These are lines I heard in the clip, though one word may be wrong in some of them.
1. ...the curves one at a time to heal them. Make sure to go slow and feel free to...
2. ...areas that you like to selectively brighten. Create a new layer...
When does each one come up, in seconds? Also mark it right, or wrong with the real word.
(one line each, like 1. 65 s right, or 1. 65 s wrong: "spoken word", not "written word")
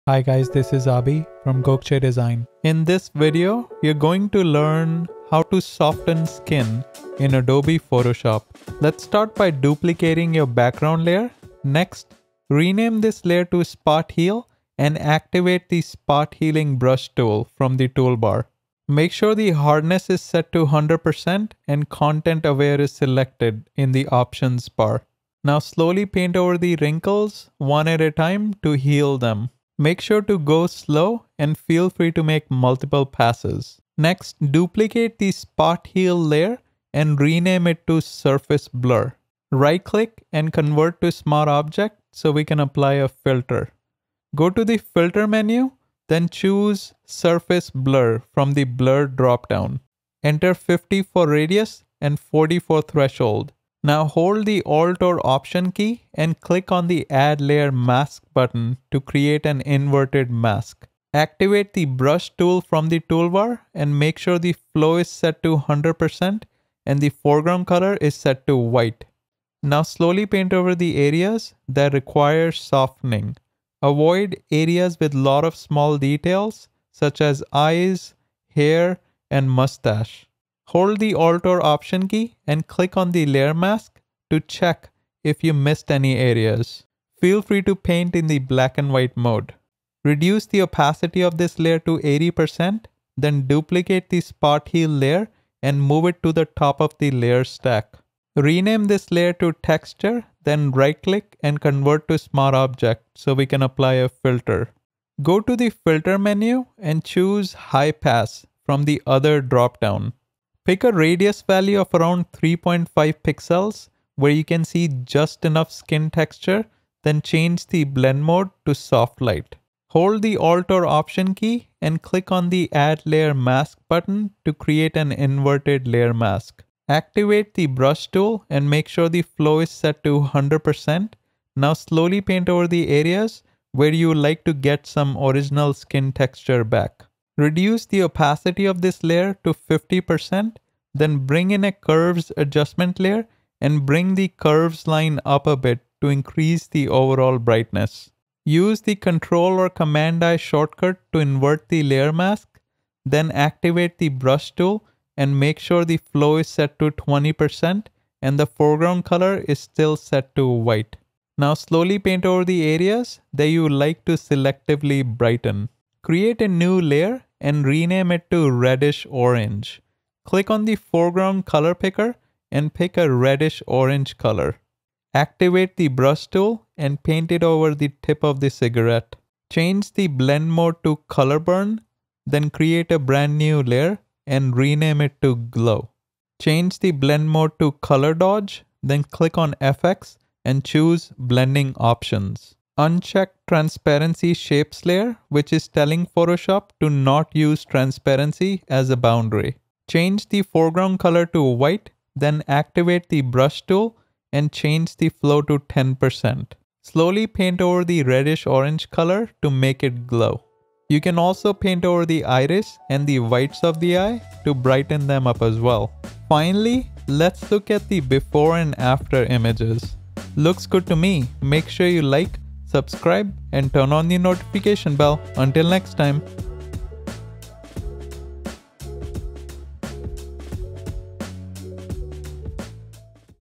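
1. 26 s wrong: "wrinkles", not "curves"
2. 162 s right.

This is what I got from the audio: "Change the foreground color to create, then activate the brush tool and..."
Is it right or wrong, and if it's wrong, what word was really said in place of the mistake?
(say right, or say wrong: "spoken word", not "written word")
wrong: "white", not "create".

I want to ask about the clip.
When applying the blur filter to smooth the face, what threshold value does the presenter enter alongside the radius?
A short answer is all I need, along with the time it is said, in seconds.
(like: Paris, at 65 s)
40, at 52 s.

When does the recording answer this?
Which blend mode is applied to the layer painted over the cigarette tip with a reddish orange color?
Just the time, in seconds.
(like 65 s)
181 s.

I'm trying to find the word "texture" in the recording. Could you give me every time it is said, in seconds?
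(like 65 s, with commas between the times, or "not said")
99 s, 116 s, 136 s.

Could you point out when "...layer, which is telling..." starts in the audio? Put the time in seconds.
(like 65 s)
194 s.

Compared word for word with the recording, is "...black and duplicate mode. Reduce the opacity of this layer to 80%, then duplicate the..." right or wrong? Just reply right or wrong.
wrong.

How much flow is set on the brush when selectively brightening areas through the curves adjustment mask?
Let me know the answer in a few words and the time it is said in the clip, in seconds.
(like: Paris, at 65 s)
20%, at 156 s.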